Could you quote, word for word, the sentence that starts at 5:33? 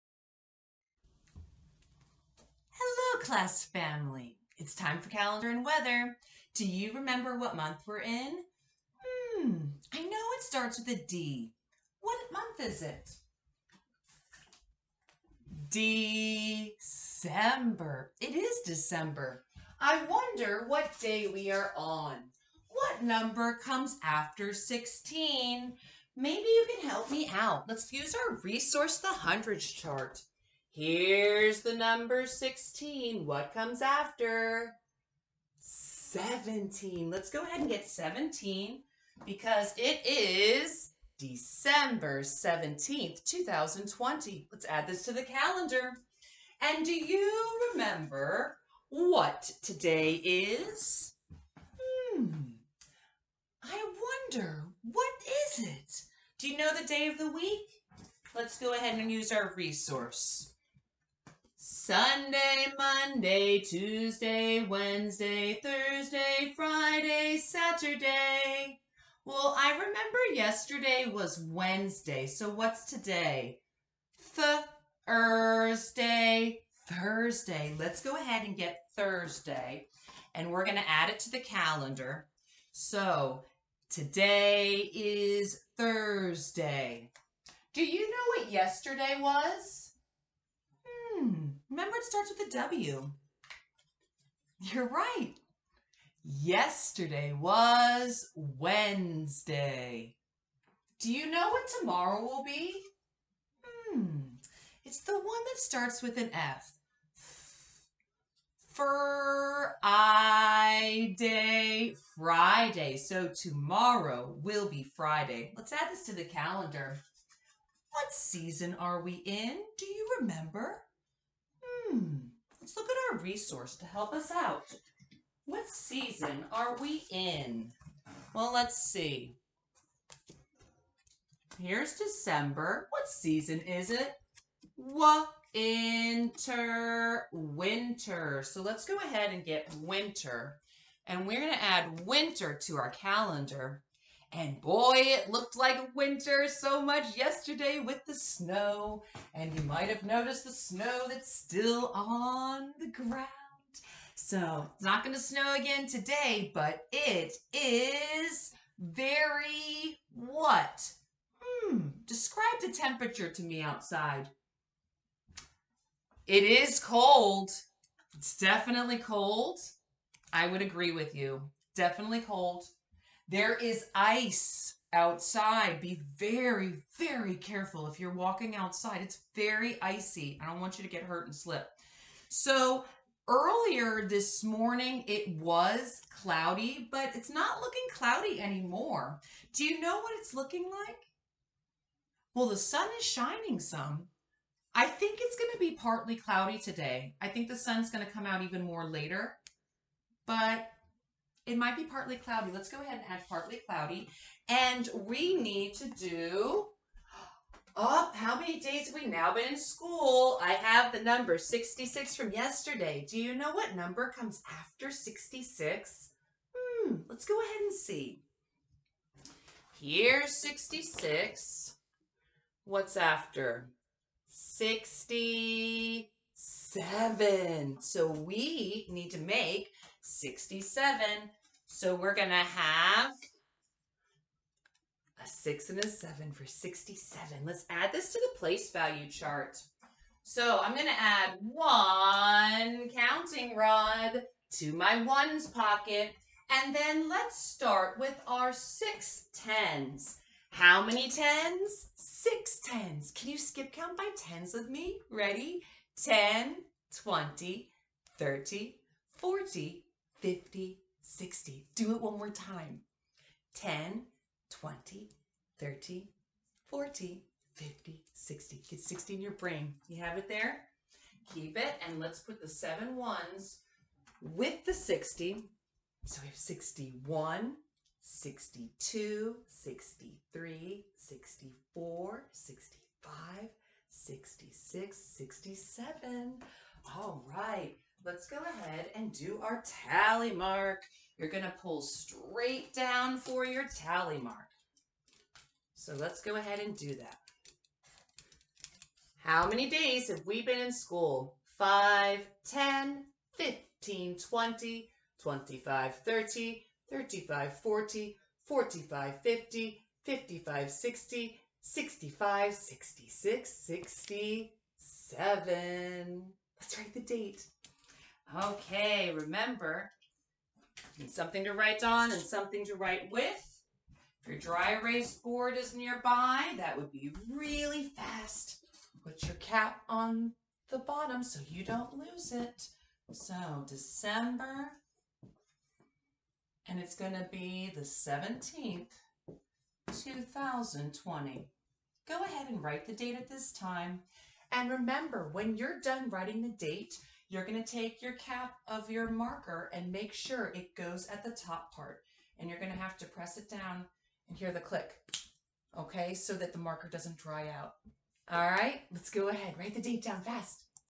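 So December, and it's going to be the 17th.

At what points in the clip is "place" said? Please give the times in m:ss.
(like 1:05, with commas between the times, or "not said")
3:58.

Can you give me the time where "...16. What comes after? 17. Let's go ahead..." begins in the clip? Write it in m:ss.
0:32.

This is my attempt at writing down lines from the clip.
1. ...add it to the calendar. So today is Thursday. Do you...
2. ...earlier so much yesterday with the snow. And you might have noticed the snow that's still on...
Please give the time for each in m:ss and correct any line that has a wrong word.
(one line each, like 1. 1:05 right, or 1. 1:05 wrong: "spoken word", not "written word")
1. 1:20 right
2. 2:25 wrong: "winter", not "earlier".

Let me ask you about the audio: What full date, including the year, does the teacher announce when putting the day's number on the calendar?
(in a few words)
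December 17th, 2020.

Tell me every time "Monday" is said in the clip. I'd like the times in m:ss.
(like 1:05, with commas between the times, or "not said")
1:02.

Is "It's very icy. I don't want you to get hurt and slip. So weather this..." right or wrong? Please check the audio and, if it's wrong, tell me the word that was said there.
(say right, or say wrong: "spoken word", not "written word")
wrong: "earlier", not "weather".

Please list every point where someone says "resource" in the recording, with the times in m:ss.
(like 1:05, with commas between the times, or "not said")
0:28, 0:59, 2:03.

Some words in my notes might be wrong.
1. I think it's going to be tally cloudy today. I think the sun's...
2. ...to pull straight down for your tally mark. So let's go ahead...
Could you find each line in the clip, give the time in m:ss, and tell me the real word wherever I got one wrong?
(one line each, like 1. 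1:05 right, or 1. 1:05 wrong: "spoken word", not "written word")
1. 3:14 wrong: "partly", not "tally"
2. 4:51 right.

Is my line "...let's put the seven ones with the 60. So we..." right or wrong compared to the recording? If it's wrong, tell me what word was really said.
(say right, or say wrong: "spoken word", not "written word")
right.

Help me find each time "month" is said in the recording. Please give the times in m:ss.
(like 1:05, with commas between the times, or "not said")
0:07, 0:12.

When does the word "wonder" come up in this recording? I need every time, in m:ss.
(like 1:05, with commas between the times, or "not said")
0:20, 0:54.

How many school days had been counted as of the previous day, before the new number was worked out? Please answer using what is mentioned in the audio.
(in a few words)
66.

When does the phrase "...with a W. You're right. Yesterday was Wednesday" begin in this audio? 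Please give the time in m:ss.
1:32.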